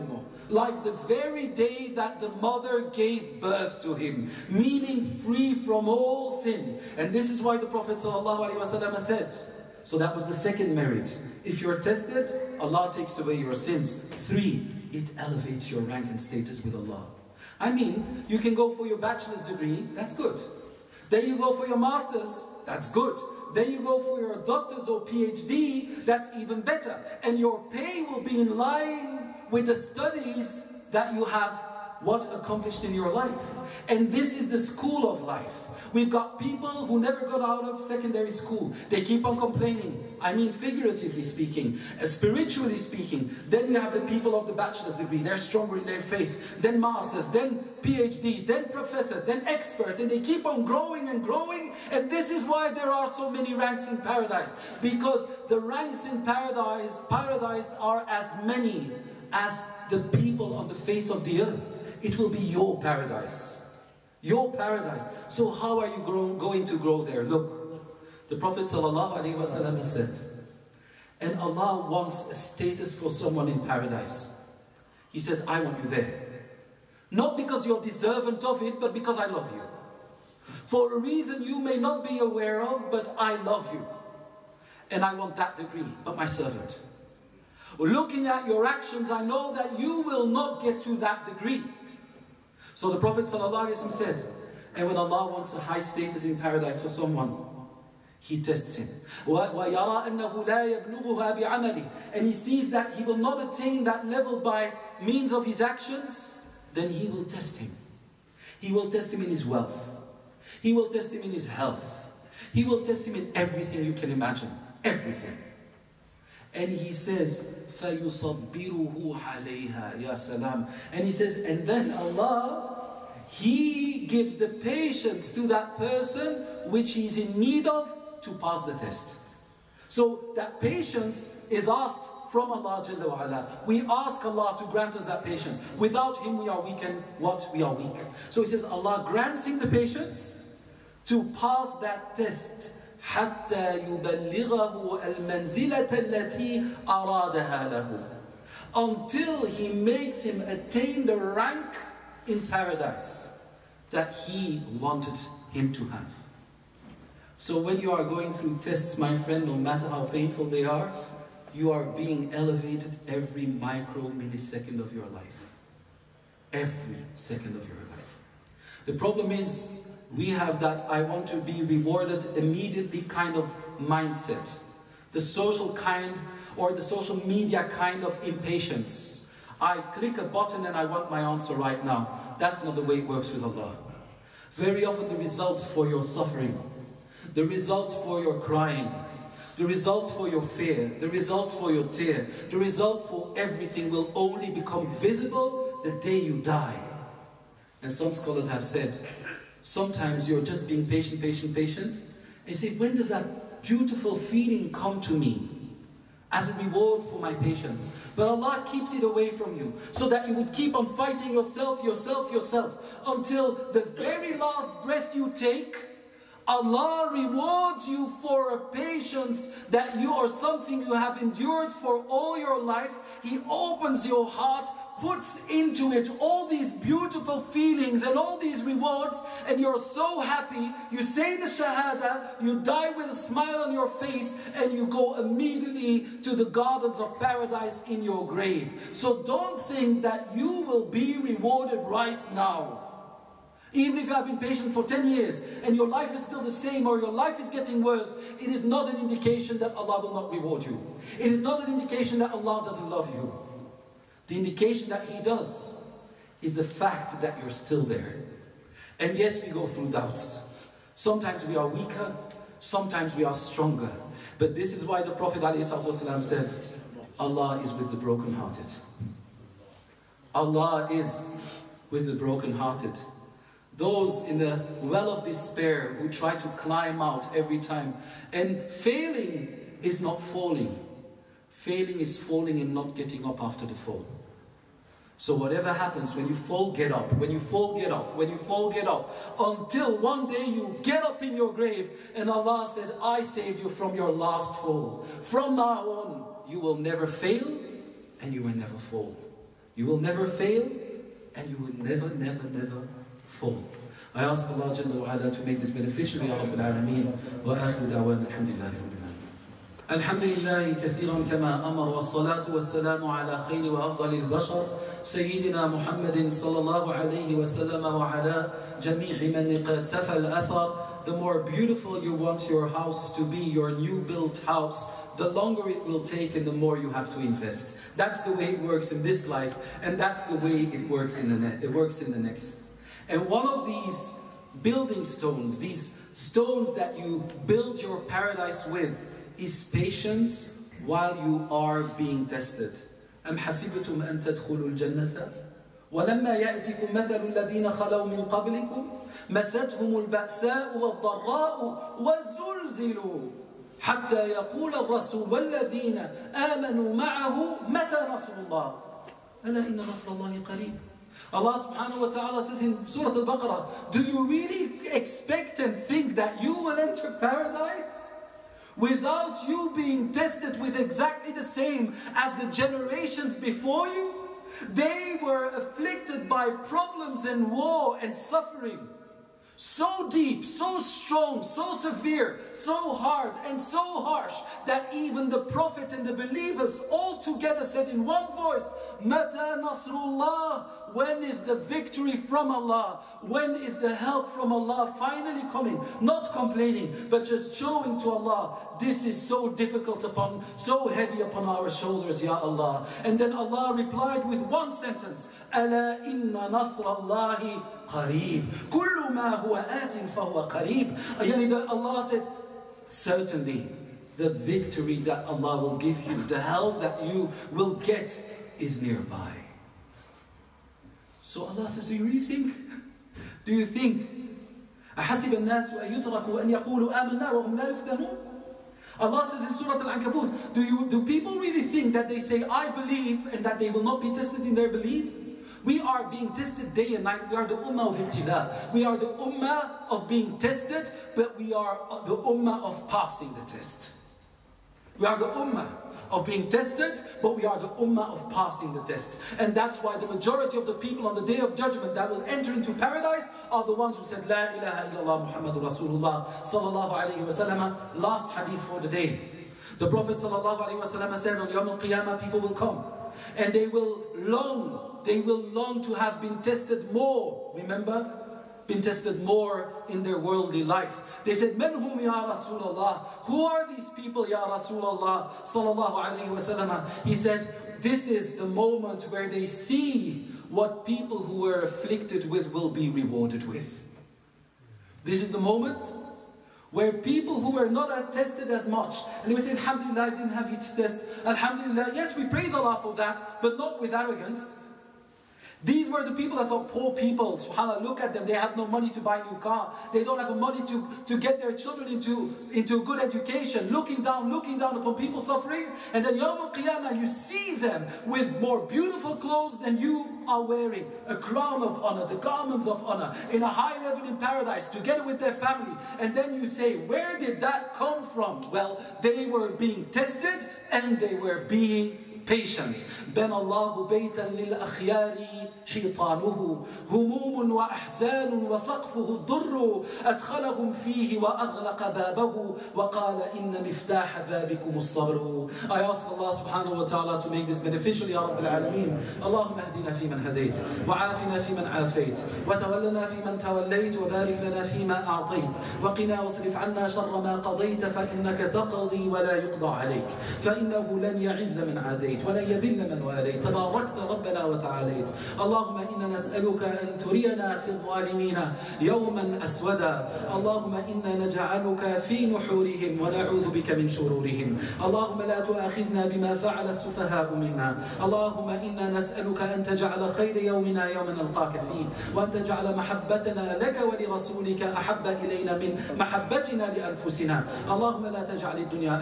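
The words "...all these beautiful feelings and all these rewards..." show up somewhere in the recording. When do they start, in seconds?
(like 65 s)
226 s.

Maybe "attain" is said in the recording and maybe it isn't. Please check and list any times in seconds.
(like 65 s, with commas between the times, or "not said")
103 s, 150 s.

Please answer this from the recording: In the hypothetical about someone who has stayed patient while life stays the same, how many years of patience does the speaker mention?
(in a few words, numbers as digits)
10.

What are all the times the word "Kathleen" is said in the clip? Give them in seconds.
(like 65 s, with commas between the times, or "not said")
not said.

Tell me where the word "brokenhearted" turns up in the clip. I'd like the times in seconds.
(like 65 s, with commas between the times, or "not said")
267 s, 272 s.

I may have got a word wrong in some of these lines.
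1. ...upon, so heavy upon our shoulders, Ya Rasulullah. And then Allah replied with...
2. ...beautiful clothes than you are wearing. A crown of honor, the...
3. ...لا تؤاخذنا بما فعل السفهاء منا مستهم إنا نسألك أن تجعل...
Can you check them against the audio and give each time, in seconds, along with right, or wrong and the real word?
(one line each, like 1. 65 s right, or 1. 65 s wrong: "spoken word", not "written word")
1. 400 s wrong: "Allah", not "Rasulullah"
2. 508 s right
3. 565 s wrong: "اللهم", not "مستهم".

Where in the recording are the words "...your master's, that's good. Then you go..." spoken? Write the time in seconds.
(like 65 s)
21 s.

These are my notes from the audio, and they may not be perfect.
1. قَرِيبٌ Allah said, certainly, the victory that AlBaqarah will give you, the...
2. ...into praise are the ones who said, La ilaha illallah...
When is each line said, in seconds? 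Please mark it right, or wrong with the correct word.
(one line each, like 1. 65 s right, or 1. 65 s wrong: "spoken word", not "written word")
1. 411 s wrong: "Allah", not "AlBaqarah"
2. 452 s wrong: "paradise", not "praise".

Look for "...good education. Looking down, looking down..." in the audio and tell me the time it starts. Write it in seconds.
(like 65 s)
502 s.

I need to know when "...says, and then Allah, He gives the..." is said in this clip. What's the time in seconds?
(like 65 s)
121 s.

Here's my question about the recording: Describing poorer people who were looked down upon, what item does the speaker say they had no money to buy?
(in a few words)
a new car.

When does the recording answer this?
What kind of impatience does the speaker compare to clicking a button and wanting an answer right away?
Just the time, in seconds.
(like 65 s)
176 s.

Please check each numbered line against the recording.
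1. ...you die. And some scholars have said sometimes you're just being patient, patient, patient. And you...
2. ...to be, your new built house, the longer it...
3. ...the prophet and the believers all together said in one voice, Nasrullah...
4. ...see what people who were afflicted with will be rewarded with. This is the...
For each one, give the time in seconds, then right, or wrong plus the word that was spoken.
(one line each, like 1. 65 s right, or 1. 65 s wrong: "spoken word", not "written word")
1. 196 s right
2. 323 s right
3. 385 s wrong: "Mata", not "Nasrullah"
4. 479 s right.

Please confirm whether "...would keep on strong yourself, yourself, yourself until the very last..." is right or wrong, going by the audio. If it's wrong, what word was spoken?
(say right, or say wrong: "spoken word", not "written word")
wrong: "fighting", not "strong".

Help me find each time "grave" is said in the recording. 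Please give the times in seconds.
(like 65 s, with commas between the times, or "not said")
238 s, 291 s.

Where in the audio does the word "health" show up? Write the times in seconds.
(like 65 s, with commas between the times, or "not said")
111 s.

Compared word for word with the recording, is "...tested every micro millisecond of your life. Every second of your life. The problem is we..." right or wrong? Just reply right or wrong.
wrong.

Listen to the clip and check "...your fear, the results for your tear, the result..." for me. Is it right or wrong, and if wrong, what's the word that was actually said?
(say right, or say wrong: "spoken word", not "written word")
right.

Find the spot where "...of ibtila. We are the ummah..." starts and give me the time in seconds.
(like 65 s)
437 s.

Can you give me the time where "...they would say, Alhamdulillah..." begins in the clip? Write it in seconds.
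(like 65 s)
489 s.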